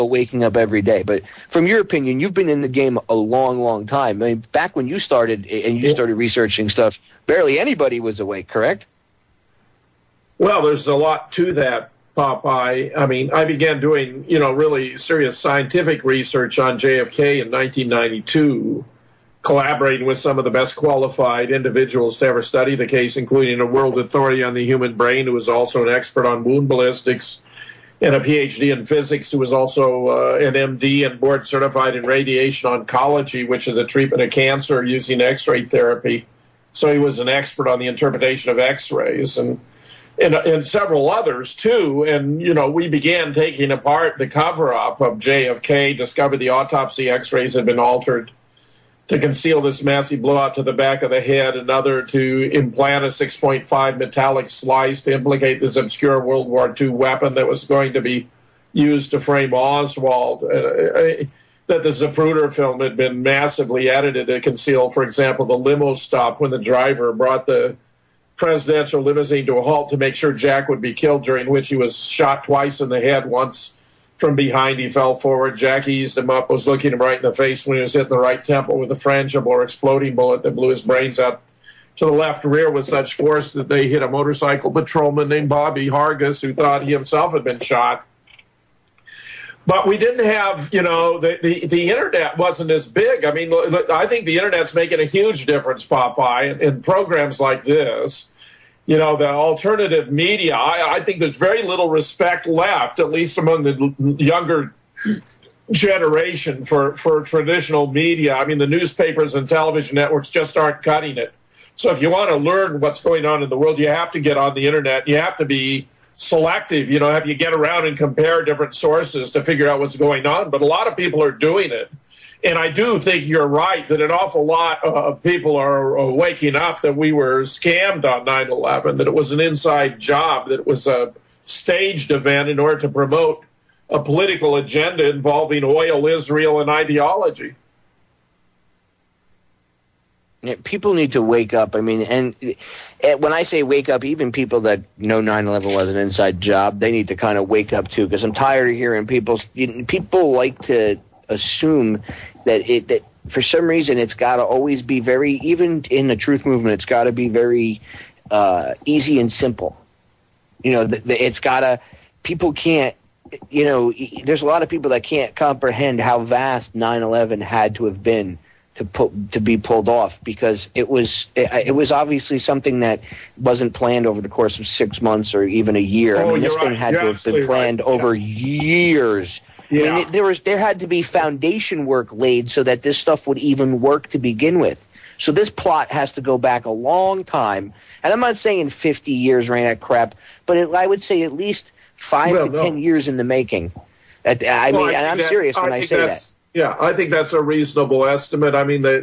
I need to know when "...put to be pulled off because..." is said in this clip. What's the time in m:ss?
2:48.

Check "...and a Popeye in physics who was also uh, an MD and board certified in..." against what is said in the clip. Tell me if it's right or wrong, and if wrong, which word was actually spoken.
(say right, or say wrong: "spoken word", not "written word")
wrong: "PhD", not "Popeye".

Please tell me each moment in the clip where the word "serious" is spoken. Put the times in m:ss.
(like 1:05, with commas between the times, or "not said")
0:14, 3:15.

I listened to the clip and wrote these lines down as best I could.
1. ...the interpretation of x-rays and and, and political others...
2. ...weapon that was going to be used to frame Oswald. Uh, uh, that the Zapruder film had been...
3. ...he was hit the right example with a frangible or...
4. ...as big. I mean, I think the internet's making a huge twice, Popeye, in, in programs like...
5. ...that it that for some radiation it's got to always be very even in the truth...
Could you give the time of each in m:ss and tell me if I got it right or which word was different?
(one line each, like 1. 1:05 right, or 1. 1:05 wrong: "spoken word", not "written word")
1. 0:37 wrong: "several", not "political"
2. 0:56 right
3. 1:17 wrong: "temple", not "example"
4. 1:32 wrong: "difference", not "twice"
5. 2:32 wrong: "reason", not "radiation".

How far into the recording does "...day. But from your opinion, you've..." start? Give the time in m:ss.
0:00.